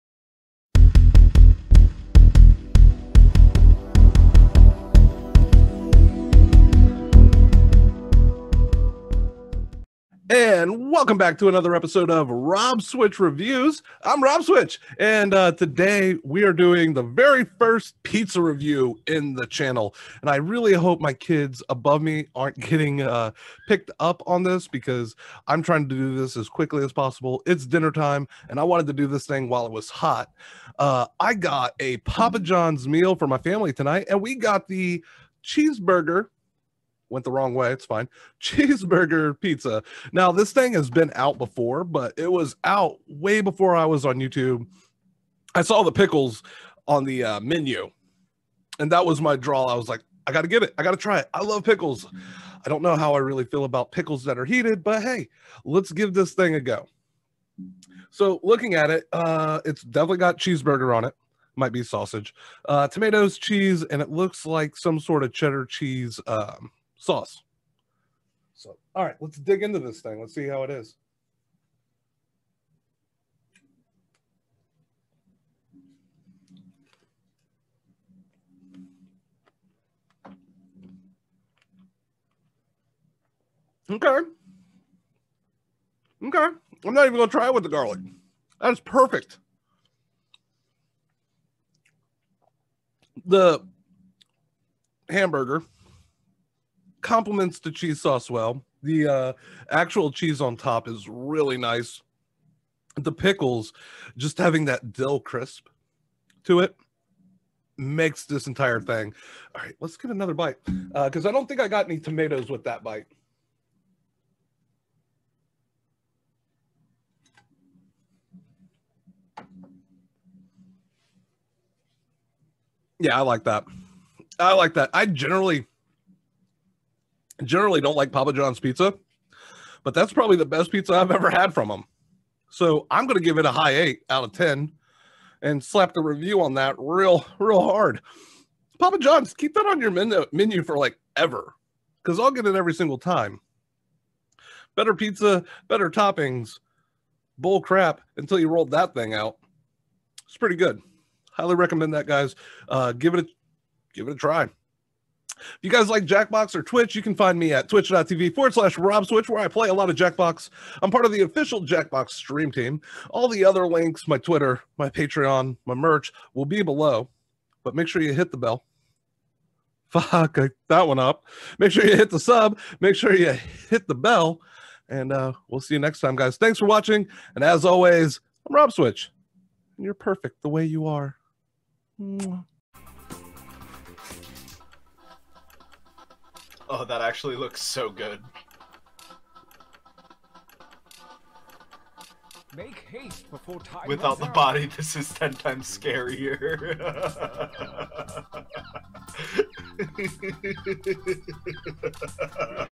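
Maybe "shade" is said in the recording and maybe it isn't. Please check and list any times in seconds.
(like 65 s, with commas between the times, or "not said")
not said.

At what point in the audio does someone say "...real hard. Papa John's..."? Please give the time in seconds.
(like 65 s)
137 s.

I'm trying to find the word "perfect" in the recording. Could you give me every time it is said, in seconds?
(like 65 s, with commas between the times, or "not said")
88 s, 179 s.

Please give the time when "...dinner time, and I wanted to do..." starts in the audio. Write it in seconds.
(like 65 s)
27 s.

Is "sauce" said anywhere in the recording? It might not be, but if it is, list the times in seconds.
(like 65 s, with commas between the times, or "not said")
67 s, 97 s.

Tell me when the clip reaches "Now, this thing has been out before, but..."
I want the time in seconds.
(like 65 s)
40 s.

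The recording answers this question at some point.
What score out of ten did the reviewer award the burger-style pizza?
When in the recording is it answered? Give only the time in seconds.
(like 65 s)
133 s.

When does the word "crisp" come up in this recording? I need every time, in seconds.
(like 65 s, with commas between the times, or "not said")
105 s.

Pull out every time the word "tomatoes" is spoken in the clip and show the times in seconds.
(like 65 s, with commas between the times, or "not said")
62 s, 111 s.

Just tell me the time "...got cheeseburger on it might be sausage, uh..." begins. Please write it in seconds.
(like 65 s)
60 s.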